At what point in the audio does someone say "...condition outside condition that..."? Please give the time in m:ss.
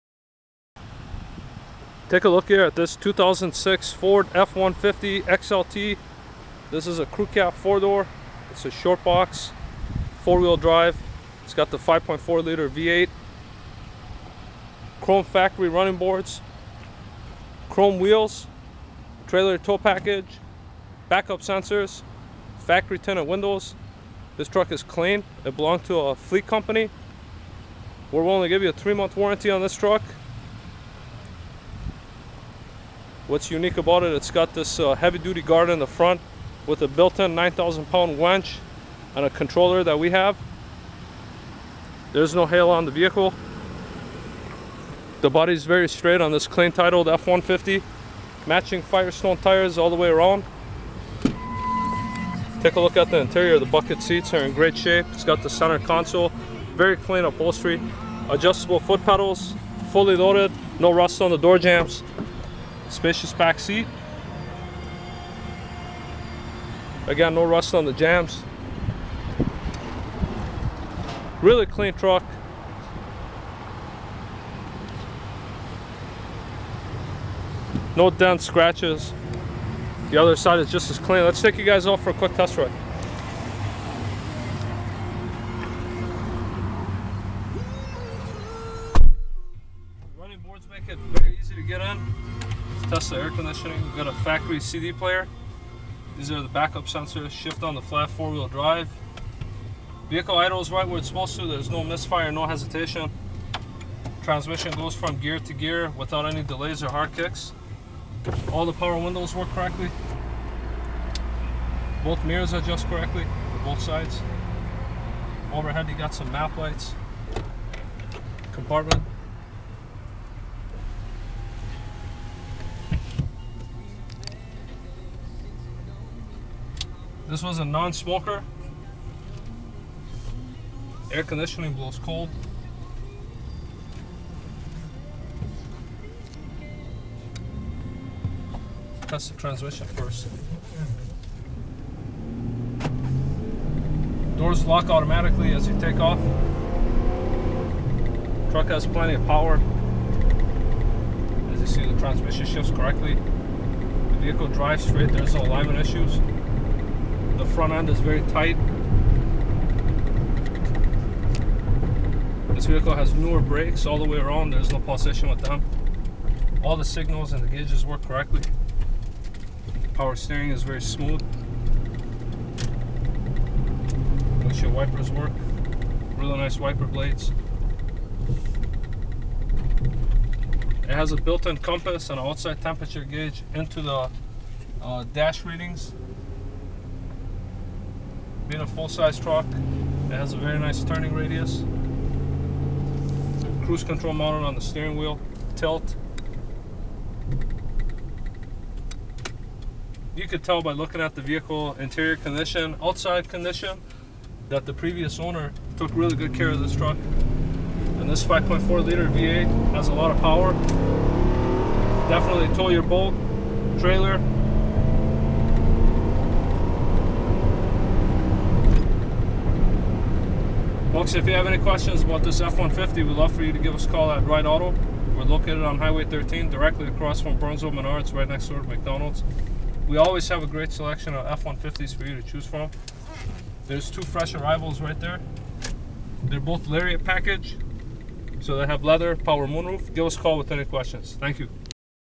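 3:22.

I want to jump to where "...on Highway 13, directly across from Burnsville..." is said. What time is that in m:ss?
3:45.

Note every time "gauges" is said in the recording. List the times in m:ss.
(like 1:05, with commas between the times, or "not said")
2:47, 3:03.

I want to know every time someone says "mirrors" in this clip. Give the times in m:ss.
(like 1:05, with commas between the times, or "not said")
1:52.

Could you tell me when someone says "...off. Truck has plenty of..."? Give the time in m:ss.
2:26.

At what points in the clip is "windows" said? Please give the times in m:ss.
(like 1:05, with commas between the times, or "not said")
0:23, 1:48.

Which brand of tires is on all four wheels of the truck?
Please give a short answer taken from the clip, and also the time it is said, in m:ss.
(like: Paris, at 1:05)
Firestone, at 0:48.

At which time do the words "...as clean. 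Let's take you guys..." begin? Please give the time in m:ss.
1:20.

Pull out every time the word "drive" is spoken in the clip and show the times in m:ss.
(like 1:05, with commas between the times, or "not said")
0:10, 1:38, 2:34.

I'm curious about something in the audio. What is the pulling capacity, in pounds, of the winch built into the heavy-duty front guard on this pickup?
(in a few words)
9,000 pounds.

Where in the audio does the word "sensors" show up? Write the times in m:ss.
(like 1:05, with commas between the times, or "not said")
0:21, 1:36.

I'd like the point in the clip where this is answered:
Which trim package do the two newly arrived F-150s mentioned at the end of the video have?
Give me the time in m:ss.
3:56.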